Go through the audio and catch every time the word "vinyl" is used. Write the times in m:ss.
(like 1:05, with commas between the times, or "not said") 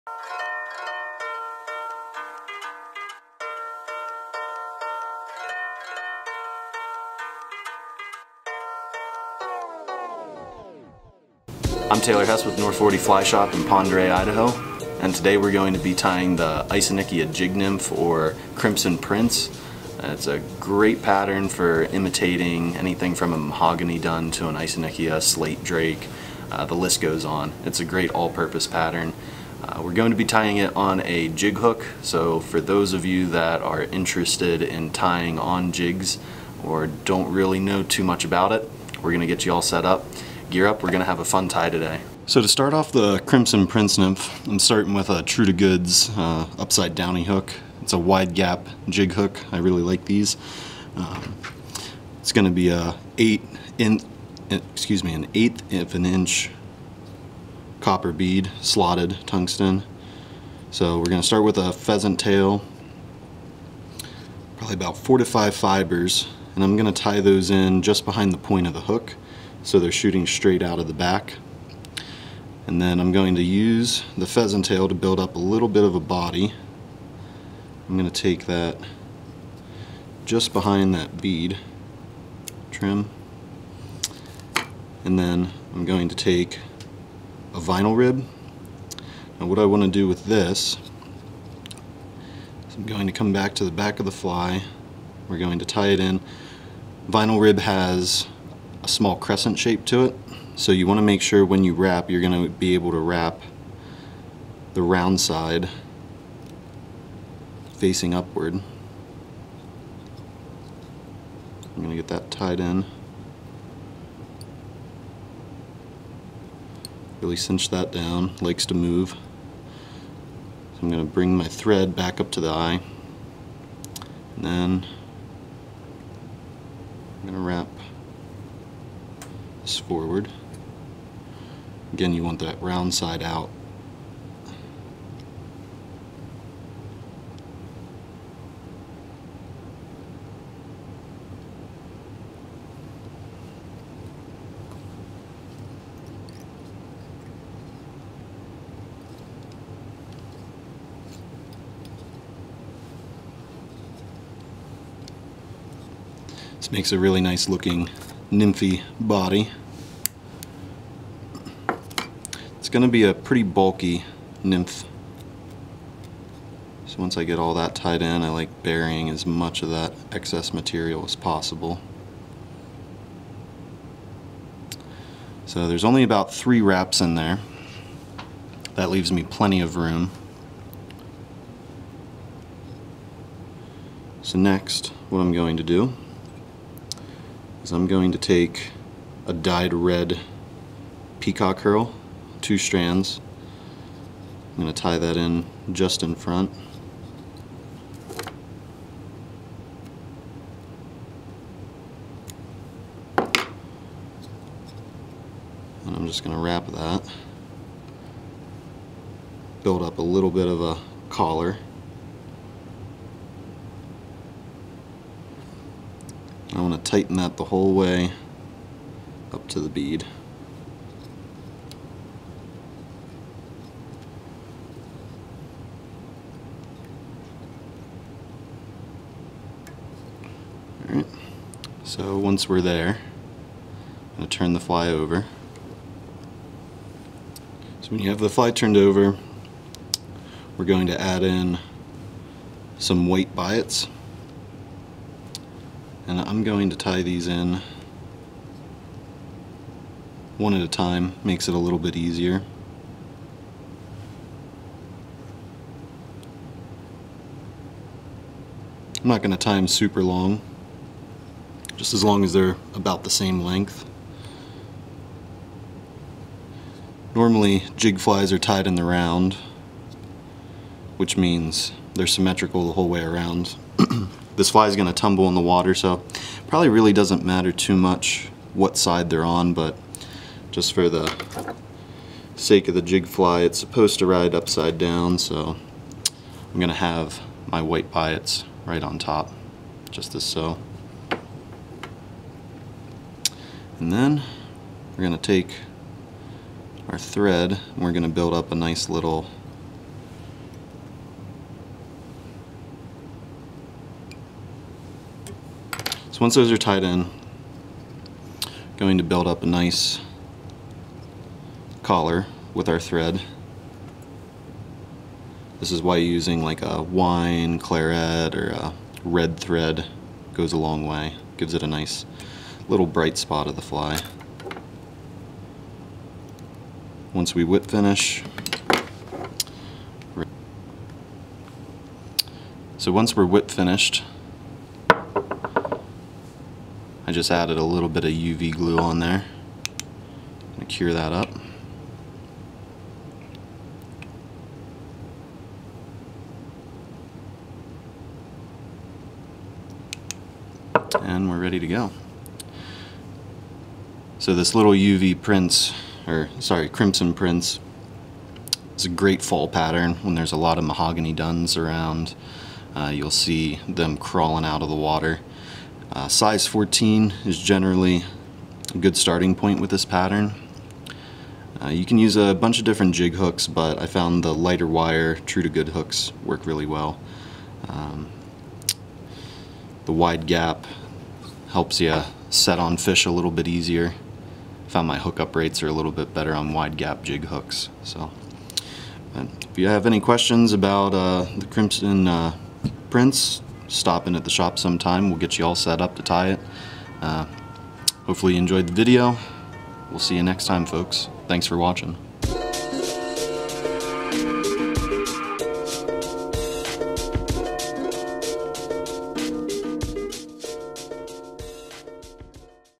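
1:27, 1:37.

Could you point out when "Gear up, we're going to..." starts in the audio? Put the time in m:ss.
0:40.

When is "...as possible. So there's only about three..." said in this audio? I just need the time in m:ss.
2:51.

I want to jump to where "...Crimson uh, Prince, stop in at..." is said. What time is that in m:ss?
6:31.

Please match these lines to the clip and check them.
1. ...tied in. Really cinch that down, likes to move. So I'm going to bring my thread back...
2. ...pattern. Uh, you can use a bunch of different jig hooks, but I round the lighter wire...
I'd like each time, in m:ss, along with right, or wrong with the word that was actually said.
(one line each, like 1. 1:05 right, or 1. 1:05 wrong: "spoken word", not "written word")
1. 1:52 right
2. 6:09 wrong: "found", not "round".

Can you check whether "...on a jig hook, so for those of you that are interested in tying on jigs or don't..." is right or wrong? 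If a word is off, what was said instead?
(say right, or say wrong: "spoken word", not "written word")
right.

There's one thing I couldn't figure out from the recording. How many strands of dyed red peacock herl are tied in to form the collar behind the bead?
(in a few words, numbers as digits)
2.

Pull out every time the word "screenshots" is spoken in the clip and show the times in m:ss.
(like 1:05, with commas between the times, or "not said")
not said.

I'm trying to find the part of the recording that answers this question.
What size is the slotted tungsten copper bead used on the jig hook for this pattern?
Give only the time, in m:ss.
0:55.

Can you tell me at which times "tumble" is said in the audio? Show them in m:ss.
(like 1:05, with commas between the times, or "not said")
4:34.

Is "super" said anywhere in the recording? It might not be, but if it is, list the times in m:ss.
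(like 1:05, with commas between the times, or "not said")
4:19.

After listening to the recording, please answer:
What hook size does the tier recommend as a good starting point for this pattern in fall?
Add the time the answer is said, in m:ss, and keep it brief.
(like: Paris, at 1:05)
14, at 6:06.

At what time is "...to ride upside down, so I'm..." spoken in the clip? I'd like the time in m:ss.
4:43.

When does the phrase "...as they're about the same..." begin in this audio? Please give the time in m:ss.
4:22.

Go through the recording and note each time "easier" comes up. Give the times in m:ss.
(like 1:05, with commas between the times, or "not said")
4:11, 6:23.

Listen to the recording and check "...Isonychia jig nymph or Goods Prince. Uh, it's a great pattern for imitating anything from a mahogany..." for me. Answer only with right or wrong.
wrong.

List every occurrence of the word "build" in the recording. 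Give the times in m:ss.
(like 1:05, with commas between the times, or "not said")
1:14, 3:29, 4:58, 5:09.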